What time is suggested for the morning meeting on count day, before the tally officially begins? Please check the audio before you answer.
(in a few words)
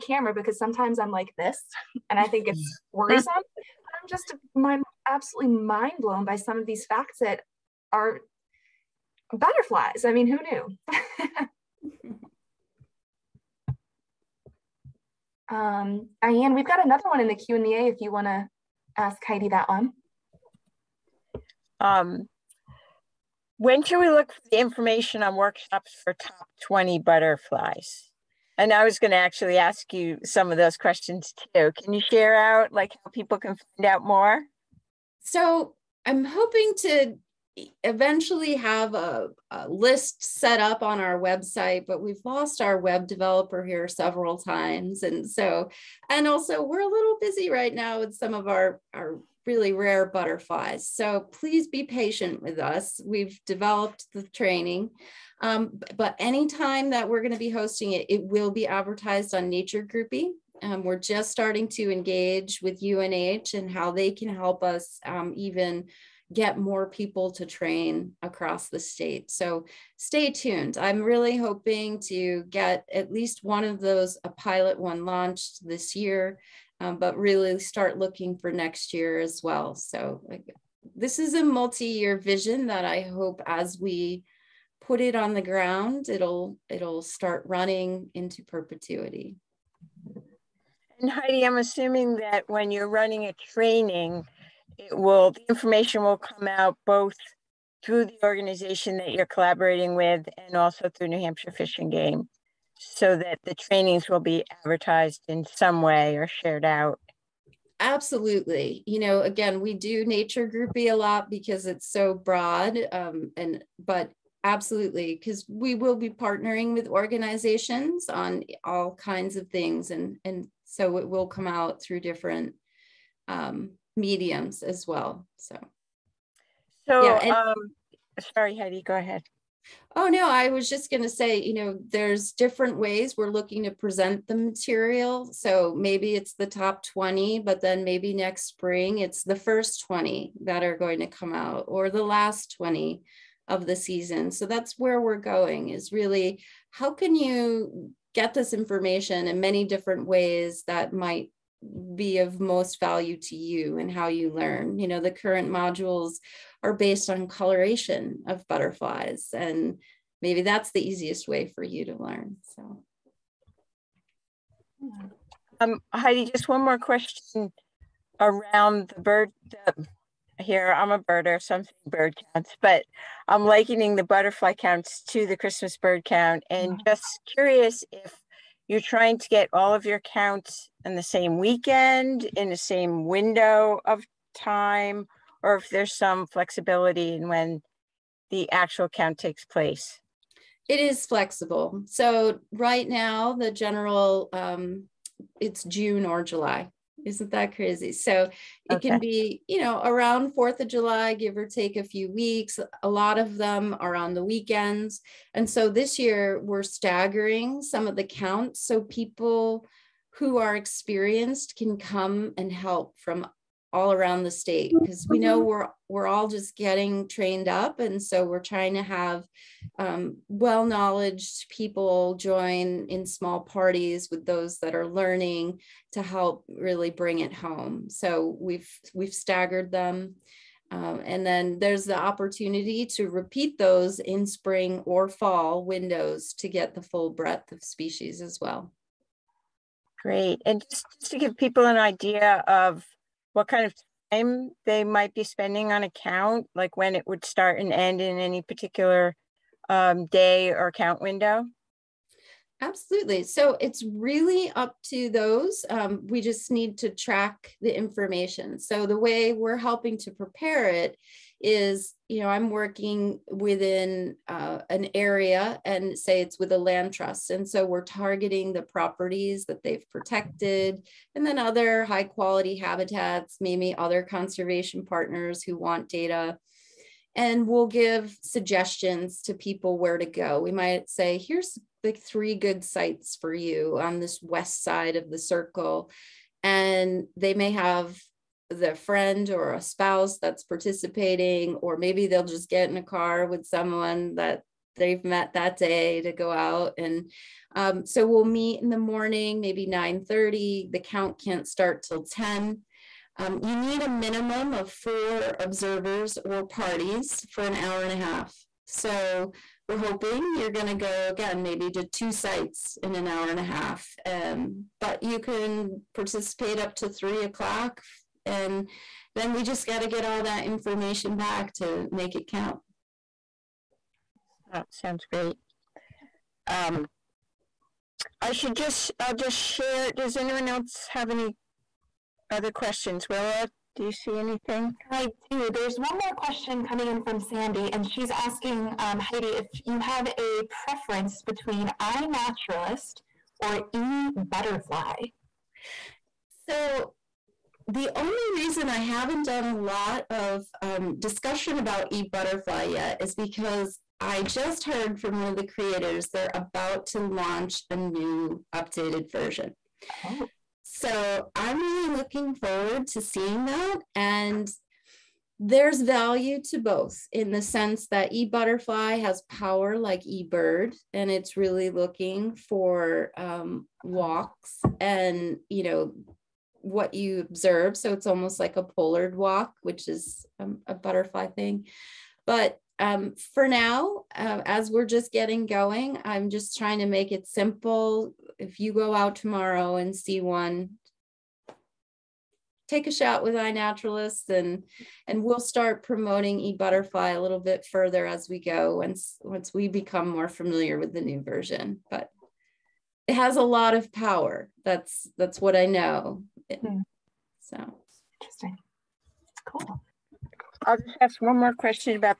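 9:30.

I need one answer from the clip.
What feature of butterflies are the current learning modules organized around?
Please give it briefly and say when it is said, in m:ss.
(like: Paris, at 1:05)
Coloration, at 2:37.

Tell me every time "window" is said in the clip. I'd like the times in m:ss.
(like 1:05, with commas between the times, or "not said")
3:03, 3:55, 4:11.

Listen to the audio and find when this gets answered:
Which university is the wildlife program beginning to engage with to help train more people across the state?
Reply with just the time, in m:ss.
1:02.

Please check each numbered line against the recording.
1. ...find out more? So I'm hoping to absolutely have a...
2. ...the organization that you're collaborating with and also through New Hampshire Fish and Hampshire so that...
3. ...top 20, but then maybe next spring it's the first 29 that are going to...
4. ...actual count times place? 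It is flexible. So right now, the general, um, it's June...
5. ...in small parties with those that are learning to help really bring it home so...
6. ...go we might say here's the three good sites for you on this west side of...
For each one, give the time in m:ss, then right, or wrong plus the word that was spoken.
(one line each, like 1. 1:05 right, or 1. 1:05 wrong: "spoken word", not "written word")
1. 0:33 wrong: "eventually", not "absolutely"
2. 1:38 wrong: "Game", not "Hampshire"
3. 2:16 wrong: "20", not "29"
4. 3:08 wrong: "takes", not "times"
5. 3:42 right
6. 4:40 right.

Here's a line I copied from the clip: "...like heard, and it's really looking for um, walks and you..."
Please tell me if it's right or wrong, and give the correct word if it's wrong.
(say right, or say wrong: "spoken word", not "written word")
wrong: "eBird", not "heard".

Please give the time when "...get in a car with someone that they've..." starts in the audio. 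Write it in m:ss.
4:52.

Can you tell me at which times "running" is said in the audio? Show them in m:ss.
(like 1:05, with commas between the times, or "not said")
1:27, 1:32.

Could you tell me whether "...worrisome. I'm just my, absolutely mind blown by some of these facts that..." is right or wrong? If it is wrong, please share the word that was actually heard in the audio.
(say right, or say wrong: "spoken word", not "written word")
right.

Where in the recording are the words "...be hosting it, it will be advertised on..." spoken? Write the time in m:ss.
0:57.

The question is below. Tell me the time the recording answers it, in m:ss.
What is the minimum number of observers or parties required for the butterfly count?
5:04.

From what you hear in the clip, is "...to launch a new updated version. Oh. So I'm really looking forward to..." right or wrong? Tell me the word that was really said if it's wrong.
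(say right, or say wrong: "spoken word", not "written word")
right.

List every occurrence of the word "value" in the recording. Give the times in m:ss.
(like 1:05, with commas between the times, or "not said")
2:32, 6:05.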